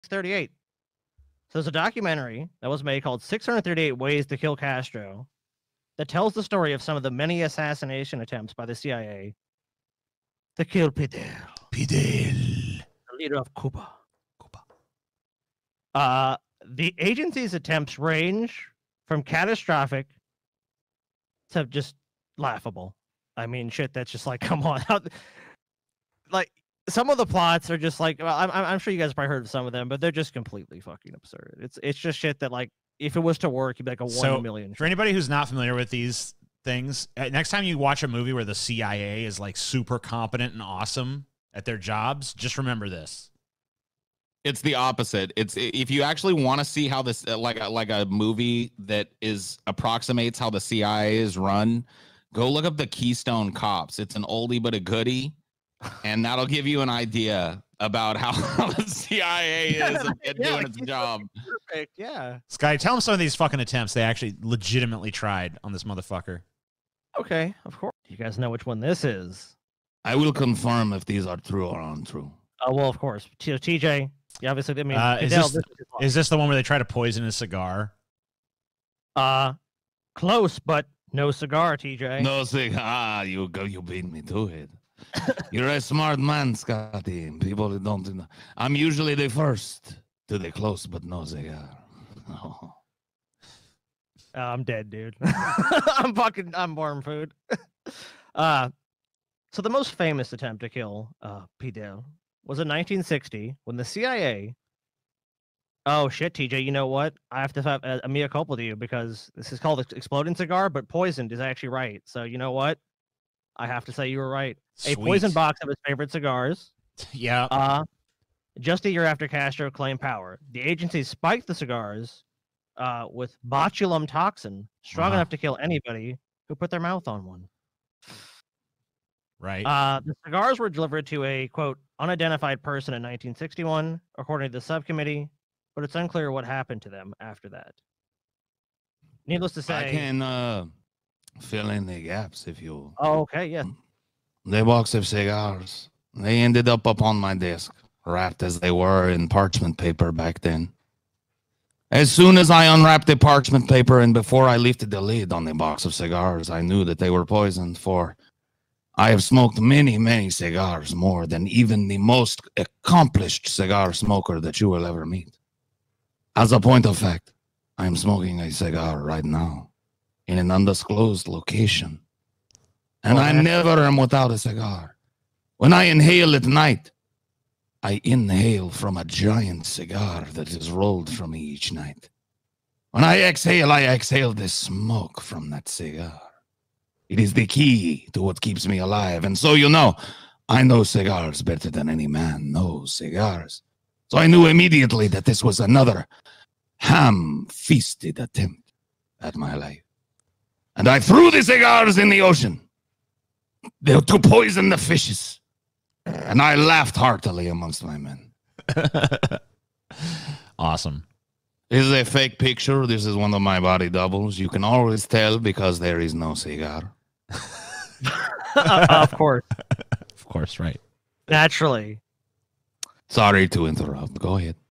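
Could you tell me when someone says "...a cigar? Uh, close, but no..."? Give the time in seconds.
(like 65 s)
77 s.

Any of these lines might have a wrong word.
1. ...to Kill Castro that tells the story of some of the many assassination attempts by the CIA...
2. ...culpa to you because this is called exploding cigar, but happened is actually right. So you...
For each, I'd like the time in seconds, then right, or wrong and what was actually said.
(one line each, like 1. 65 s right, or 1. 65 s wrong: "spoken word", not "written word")
1. 4 s right
2. 108 s wrong: "poisoned", not "happened".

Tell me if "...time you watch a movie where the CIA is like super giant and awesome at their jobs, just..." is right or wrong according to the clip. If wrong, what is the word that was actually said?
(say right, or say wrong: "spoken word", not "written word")
wrong: "competent", not "giant".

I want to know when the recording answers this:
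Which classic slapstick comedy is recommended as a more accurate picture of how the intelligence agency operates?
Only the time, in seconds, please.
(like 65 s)
52 s.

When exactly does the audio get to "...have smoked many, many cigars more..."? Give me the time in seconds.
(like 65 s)
159 s.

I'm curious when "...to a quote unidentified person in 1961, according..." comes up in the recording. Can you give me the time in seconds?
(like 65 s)
131 s.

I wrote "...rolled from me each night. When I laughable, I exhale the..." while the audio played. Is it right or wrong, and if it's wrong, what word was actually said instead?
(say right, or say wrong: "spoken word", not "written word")
wrong: "exhale", not "laughable".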